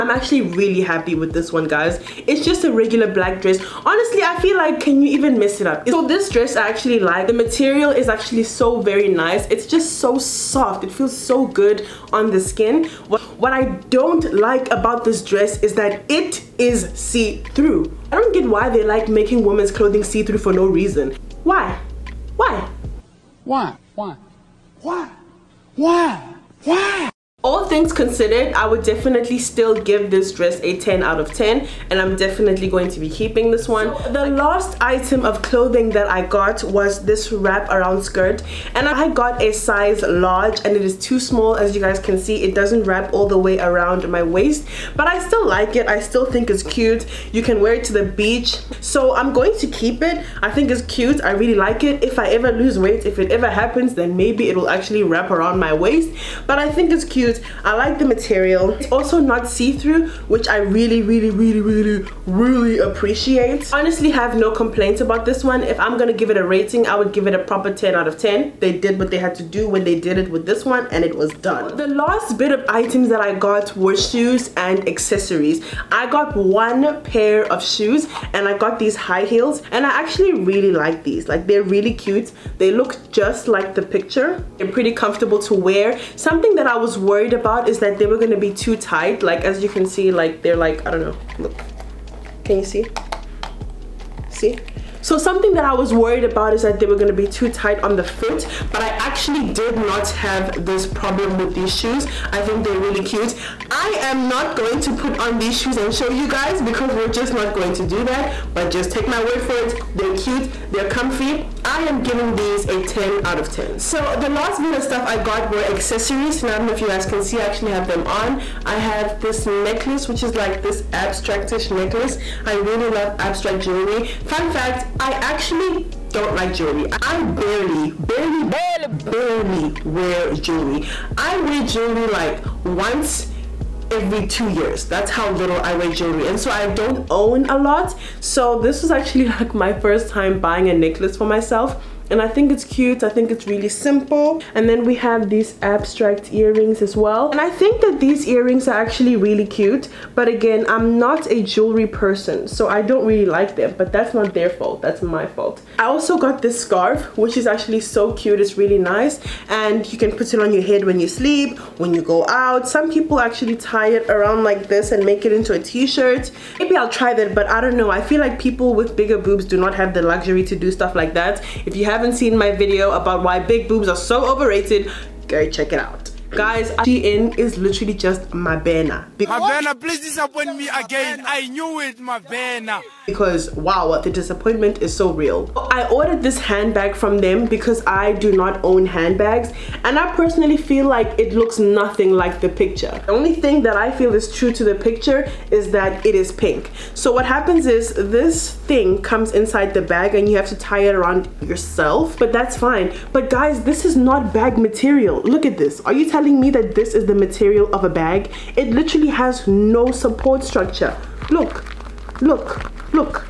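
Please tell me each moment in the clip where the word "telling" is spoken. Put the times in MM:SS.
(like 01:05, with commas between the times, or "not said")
03:26.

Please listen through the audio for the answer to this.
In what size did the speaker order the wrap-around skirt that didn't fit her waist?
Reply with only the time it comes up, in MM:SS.
00:40.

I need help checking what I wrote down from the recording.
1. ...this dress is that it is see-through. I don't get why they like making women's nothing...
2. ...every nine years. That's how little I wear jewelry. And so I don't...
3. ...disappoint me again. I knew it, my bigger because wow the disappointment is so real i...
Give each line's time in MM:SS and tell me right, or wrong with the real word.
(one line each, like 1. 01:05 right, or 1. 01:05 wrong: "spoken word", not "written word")
1. 00:15 wrong: "clothing", not "nothing"
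2. 02:13 wrong: "two", not "nine"
3. 03:00 wrong: "banner", not "bigger".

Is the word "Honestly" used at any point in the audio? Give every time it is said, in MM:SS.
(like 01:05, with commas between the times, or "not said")
00:03, 01:03.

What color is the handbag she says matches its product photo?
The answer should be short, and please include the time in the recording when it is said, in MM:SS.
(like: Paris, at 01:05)
Pink, at 03:16.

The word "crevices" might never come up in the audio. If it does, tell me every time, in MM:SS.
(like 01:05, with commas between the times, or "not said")
not said.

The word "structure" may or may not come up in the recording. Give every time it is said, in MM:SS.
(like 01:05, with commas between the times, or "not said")
03:30.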